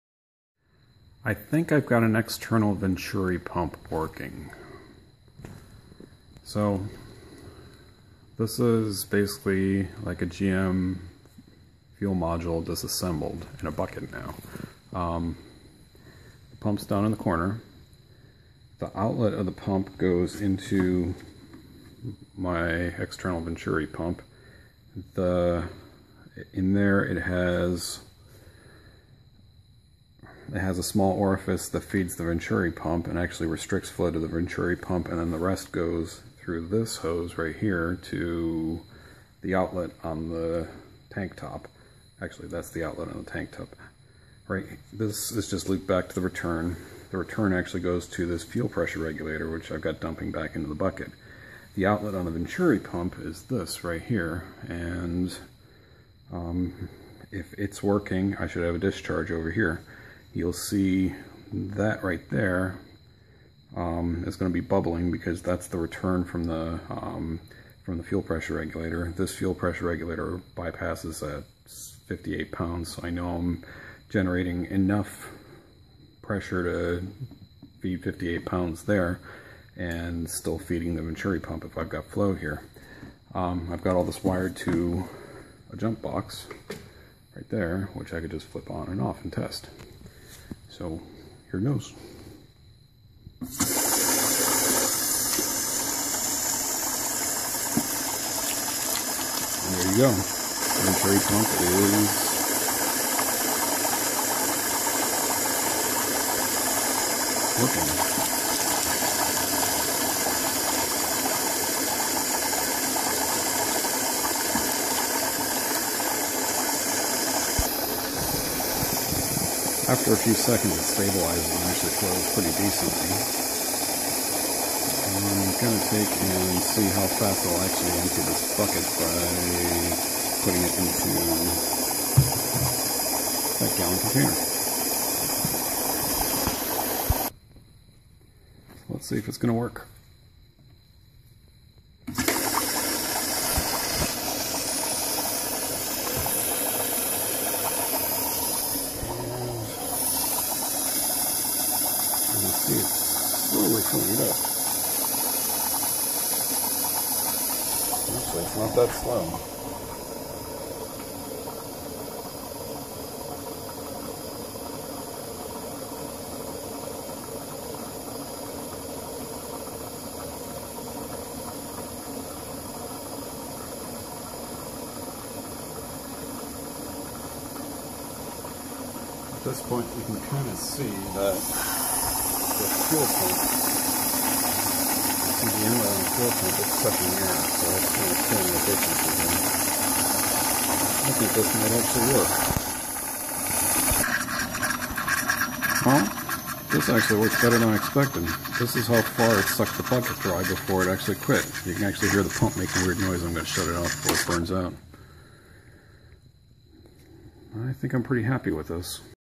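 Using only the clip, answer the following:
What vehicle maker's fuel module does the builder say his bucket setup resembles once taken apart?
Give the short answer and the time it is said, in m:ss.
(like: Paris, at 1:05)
GM, at 0:10.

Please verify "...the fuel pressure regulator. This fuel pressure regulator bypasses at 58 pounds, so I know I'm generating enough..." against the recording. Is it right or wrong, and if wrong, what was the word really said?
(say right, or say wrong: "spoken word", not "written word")
right.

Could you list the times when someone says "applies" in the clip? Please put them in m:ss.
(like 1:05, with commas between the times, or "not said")
not said.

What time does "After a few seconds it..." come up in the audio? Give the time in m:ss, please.
1:59.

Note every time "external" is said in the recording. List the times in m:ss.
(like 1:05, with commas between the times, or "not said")
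0:02, 0:22.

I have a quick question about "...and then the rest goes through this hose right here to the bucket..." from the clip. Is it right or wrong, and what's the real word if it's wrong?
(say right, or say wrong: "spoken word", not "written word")
wrong: "outlet", not "bucket".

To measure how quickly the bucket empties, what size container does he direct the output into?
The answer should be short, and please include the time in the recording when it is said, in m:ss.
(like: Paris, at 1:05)
Gallon container, at 2:13.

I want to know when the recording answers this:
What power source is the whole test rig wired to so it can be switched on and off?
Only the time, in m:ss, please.
1:25.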